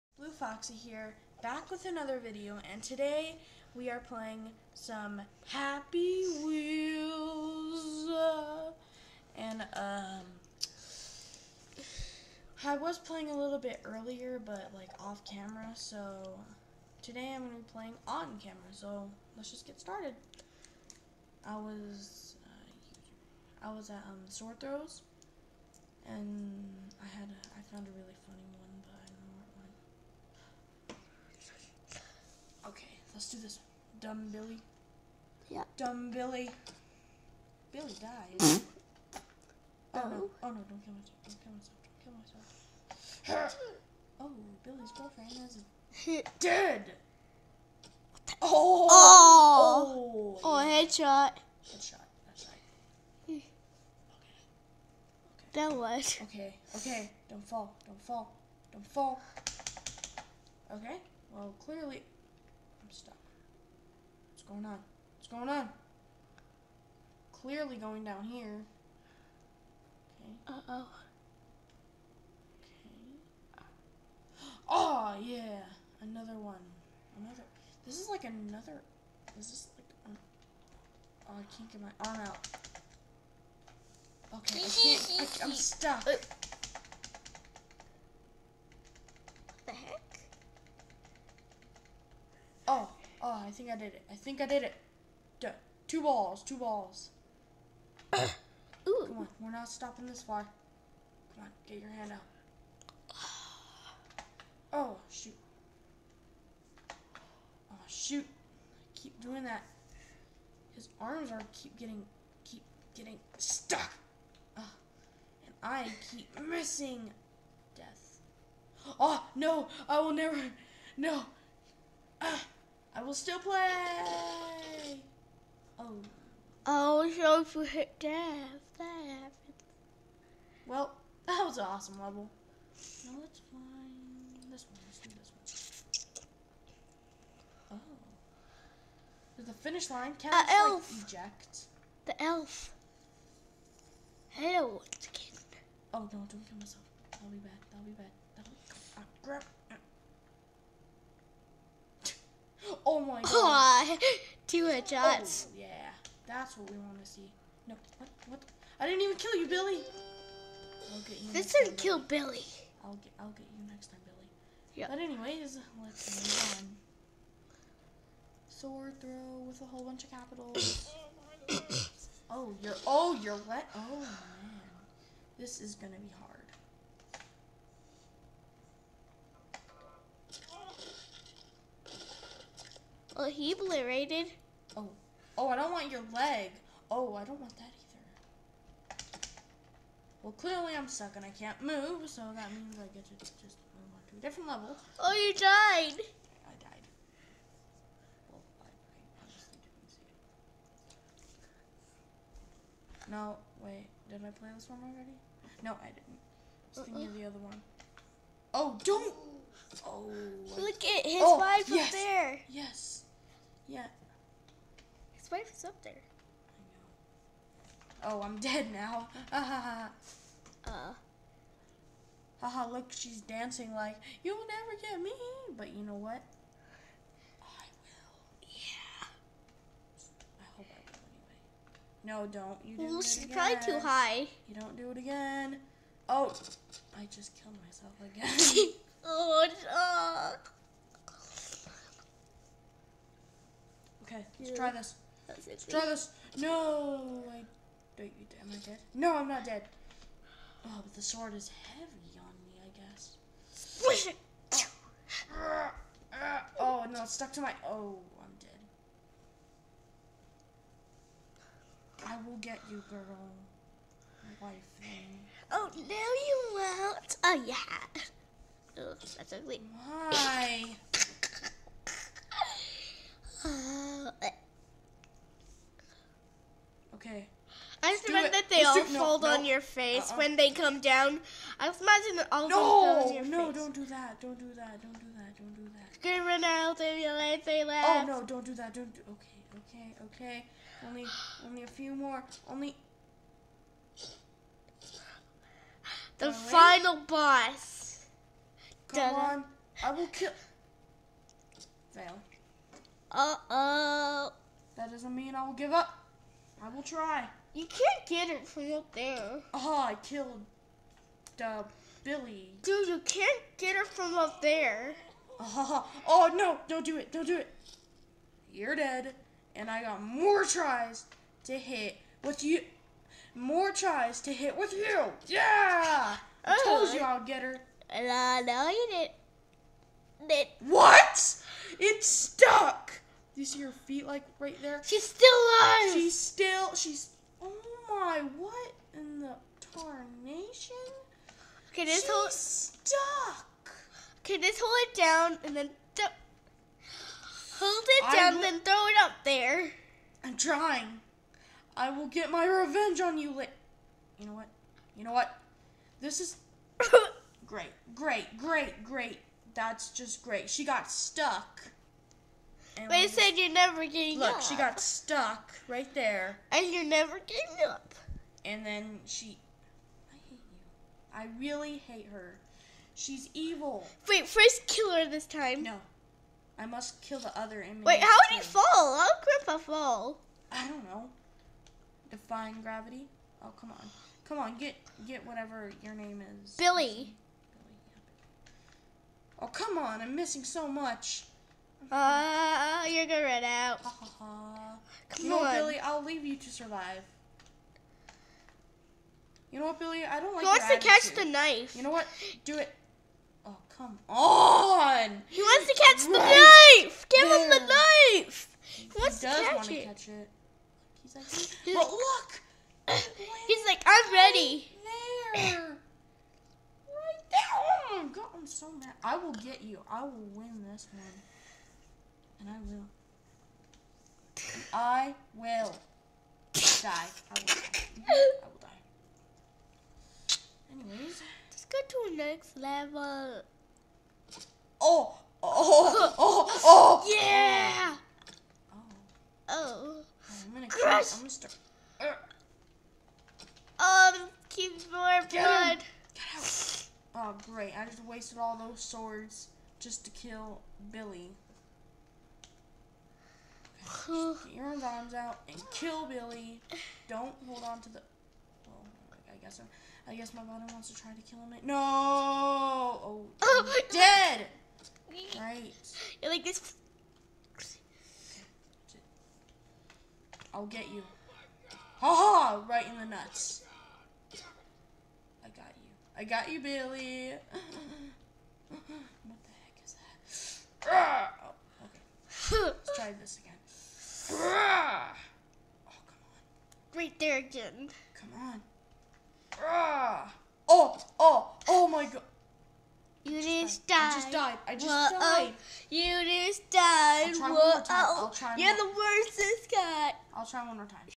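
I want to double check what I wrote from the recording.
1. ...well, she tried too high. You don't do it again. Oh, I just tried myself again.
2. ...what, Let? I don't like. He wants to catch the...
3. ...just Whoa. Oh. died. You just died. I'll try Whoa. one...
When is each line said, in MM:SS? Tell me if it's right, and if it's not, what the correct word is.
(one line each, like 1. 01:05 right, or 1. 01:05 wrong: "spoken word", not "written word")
1. 03:52 wrong: "killed", not "tried"
2. 06:39 wrong: "Billy", not "Let"
3. 08:14 right.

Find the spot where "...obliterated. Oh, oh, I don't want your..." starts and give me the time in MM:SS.
03:03.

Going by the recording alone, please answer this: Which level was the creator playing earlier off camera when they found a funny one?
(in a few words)
Sword Throws.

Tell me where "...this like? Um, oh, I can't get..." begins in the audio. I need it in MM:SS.
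01:19.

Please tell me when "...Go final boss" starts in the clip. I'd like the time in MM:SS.
04:56.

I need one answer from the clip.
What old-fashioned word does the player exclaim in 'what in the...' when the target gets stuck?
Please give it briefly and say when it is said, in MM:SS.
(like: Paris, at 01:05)
tarnation, at 05:39.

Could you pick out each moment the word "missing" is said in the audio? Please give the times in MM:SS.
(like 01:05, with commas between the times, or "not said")
01:56, 06:30.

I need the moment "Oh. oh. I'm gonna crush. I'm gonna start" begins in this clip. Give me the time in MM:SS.
07:18.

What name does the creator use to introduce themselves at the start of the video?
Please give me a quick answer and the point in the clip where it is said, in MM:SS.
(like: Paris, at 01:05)
Foxy, at 00:00.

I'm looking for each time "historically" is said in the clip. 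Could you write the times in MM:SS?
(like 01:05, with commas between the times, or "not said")
not said.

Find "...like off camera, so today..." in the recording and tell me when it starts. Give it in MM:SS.
00:14.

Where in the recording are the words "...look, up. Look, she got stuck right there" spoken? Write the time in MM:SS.
06:04.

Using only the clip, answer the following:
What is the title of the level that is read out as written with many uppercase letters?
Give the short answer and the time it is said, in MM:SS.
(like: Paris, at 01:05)
Sword throw, at 02:48.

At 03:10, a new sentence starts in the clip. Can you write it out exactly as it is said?
Well, clearly I'm stuck and I can't move, so that means I get to just move on to a different level.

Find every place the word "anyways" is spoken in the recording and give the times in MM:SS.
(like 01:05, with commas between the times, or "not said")
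02:44, 03:52, 07:10.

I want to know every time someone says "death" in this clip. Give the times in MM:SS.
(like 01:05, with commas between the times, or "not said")
01:57, 02:07.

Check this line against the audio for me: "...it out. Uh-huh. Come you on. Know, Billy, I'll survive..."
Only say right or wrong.
wrong.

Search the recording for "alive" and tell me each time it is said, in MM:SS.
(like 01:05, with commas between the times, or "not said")
05:35.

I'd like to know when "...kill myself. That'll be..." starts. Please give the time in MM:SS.
02:26.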